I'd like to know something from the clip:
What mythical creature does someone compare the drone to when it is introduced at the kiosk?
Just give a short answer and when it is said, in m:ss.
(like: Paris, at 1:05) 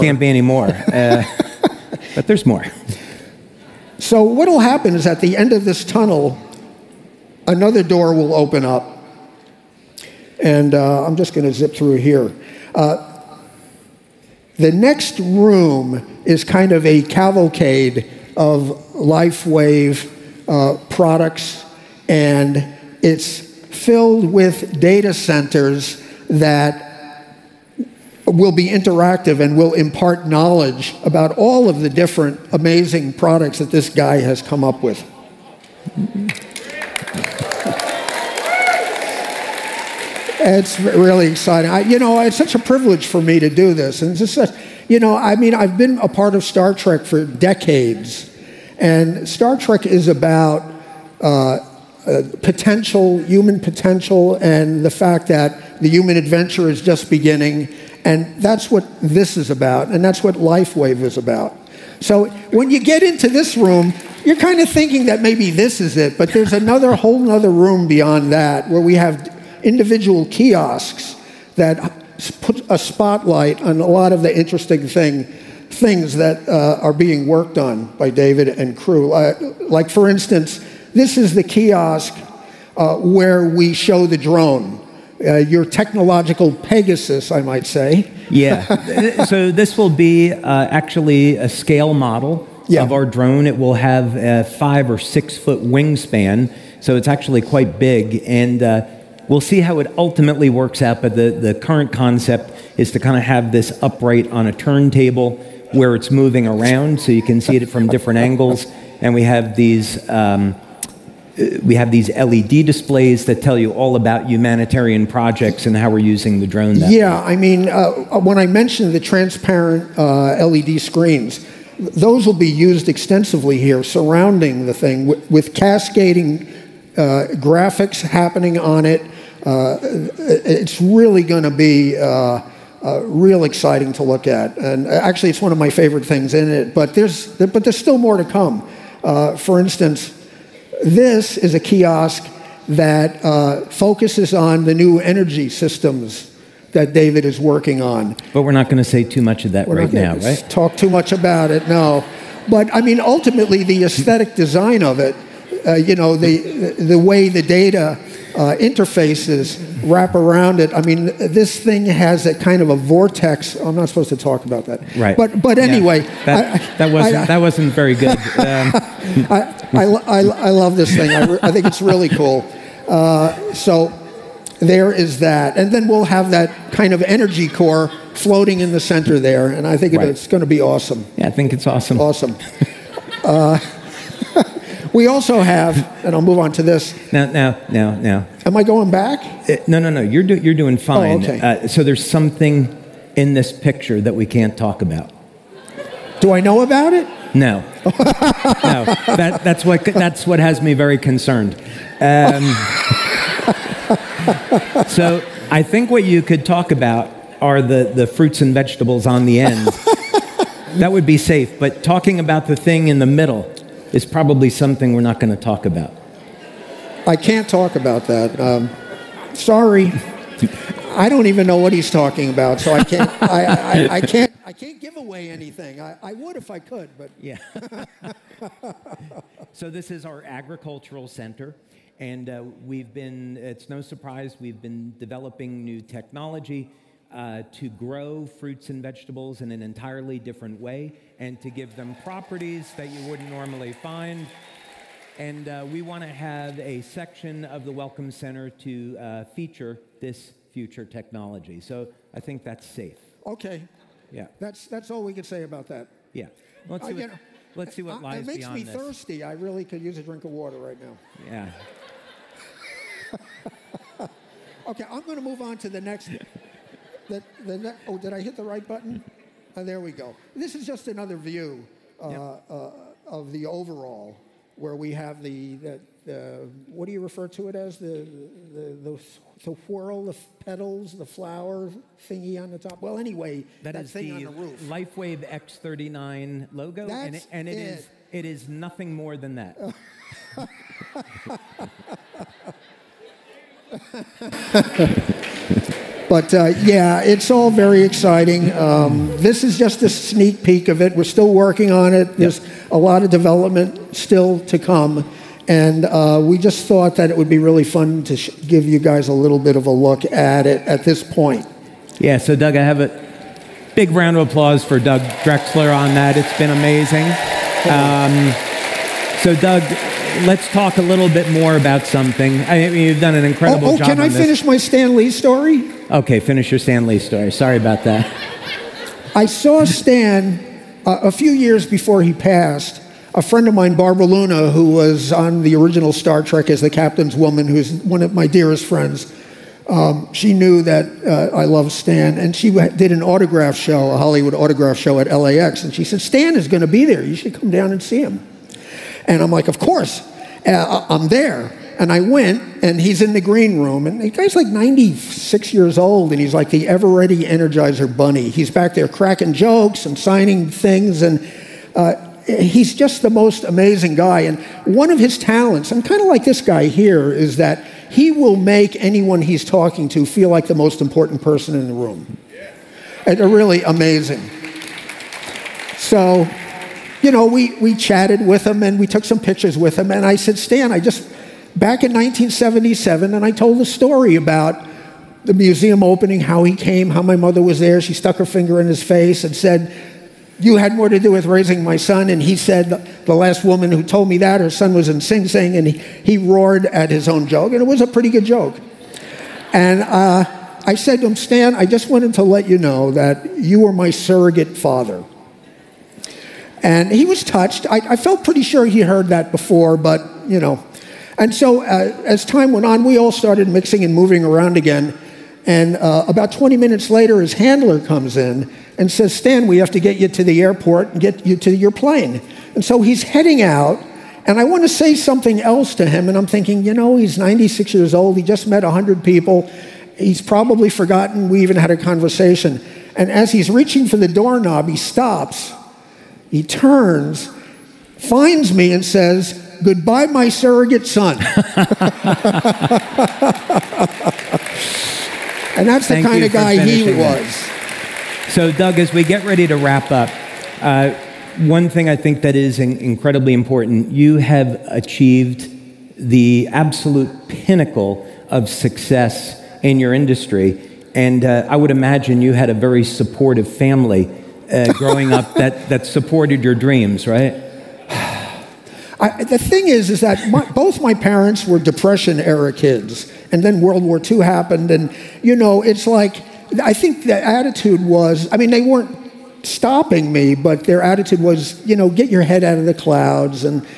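Pegasus, at 1:26.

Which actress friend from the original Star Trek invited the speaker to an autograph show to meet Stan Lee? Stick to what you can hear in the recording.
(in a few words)
Barbara Luna.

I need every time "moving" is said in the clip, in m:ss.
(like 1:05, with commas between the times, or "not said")
1:46, 6:53.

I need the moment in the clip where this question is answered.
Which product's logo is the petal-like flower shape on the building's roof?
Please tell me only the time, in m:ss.
4:44.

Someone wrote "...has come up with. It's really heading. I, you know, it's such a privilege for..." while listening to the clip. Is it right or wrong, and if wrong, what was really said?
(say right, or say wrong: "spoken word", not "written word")
wrong: "exciting", not "heading".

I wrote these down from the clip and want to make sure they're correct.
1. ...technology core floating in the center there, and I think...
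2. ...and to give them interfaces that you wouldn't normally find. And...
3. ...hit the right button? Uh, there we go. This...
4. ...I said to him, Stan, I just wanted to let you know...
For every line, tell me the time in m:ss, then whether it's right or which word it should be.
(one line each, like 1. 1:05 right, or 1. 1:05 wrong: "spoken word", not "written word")
1. 2:57 wrong: "energy", not "technology"
2. 4:01 wrong: "properties", not "interfaces"
3. 4:28 right
4. 6:40 right.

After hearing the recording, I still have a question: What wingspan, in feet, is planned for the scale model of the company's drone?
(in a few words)
5 or 6 feet.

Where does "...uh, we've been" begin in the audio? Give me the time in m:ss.
3:52.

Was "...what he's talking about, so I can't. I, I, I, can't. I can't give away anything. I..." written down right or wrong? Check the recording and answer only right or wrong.
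right.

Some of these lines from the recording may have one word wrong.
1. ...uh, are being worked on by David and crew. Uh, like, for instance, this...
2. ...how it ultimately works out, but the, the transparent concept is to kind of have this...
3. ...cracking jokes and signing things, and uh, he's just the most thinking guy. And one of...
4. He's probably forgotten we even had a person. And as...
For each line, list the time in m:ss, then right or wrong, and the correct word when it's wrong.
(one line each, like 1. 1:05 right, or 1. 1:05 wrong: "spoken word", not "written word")
1. 1:16 right
2. 1:39 wrong: "current", not "transparent"
3. 5:58 wrong: "amazing", not "thinking"
4. 7:09 wrong: "conversation", not "person".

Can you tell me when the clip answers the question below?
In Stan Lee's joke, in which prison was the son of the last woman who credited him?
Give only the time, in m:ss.
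6:34.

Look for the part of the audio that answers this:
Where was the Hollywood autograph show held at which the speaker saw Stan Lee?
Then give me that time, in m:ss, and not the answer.
5:45.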